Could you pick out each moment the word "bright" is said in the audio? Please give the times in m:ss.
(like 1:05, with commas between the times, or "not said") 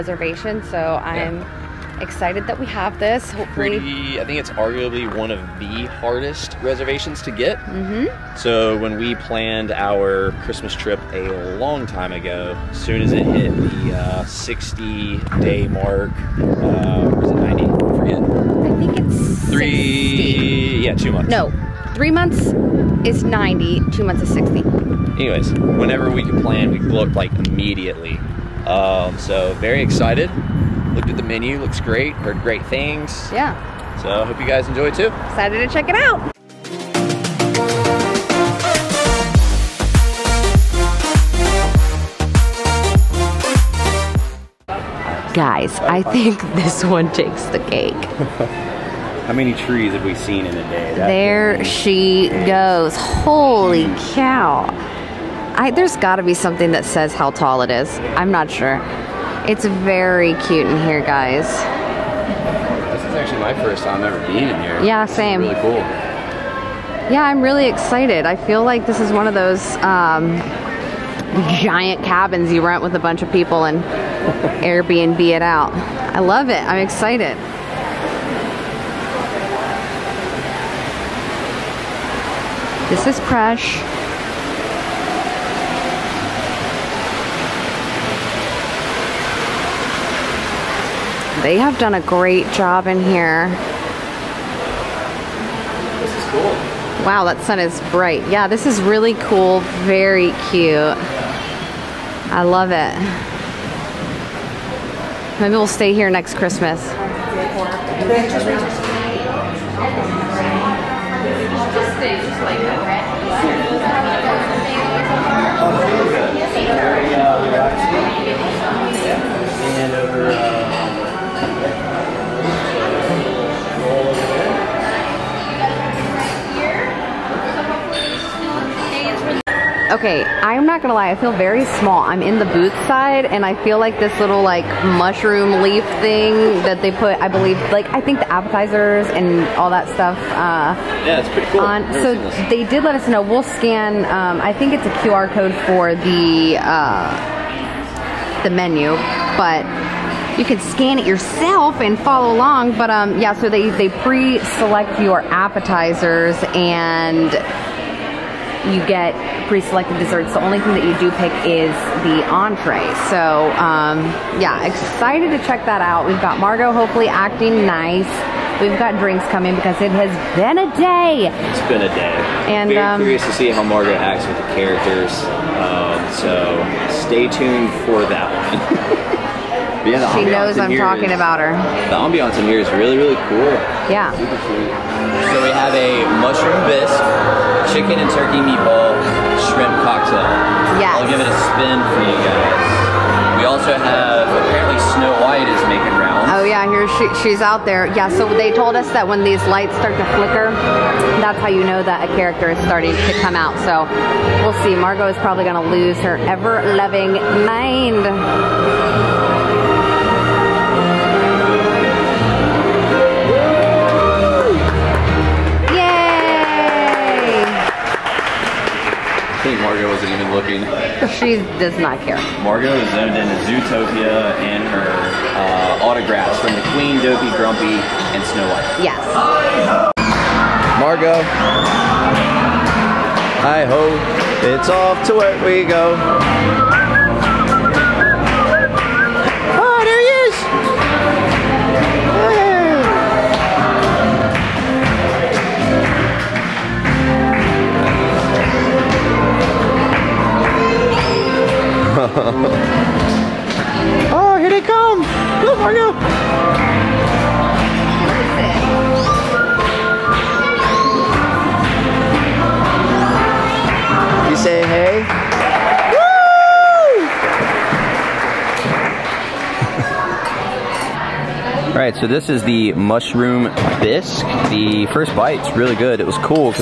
1:37.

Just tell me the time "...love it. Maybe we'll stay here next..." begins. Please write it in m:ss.
1:42.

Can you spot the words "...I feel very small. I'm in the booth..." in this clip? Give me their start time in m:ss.
2:11.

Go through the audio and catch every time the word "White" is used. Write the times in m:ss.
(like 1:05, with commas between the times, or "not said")
3:15, 3:48.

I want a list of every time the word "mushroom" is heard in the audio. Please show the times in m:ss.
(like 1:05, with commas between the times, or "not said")
2:14, 3:06, 4:32.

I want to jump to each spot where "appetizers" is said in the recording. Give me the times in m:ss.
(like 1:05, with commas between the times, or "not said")
2:18, 2:35.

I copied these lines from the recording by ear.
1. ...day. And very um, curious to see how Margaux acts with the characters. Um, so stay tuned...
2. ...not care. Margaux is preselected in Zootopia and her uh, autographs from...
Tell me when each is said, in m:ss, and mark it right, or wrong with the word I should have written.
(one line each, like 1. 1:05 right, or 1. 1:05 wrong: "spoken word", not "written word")
1. 2:51 right
2. 3:41 wrong: "owned", not "preselected".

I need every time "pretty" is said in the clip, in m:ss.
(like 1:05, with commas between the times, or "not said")
0:03, 2:21.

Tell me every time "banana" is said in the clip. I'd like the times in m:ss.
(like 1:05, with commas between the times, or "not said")
not said.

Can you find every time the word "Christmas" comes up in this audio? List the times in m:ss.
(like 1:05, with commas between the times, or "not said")
0:10, 1:46.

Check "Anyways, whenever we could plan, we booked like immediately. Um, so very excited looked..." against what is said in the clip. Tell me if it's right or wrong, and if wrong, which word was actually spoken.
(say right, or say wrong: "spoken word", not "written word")
right.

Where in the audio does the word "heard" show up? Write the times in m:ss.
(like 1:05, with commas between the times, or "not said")
0:32.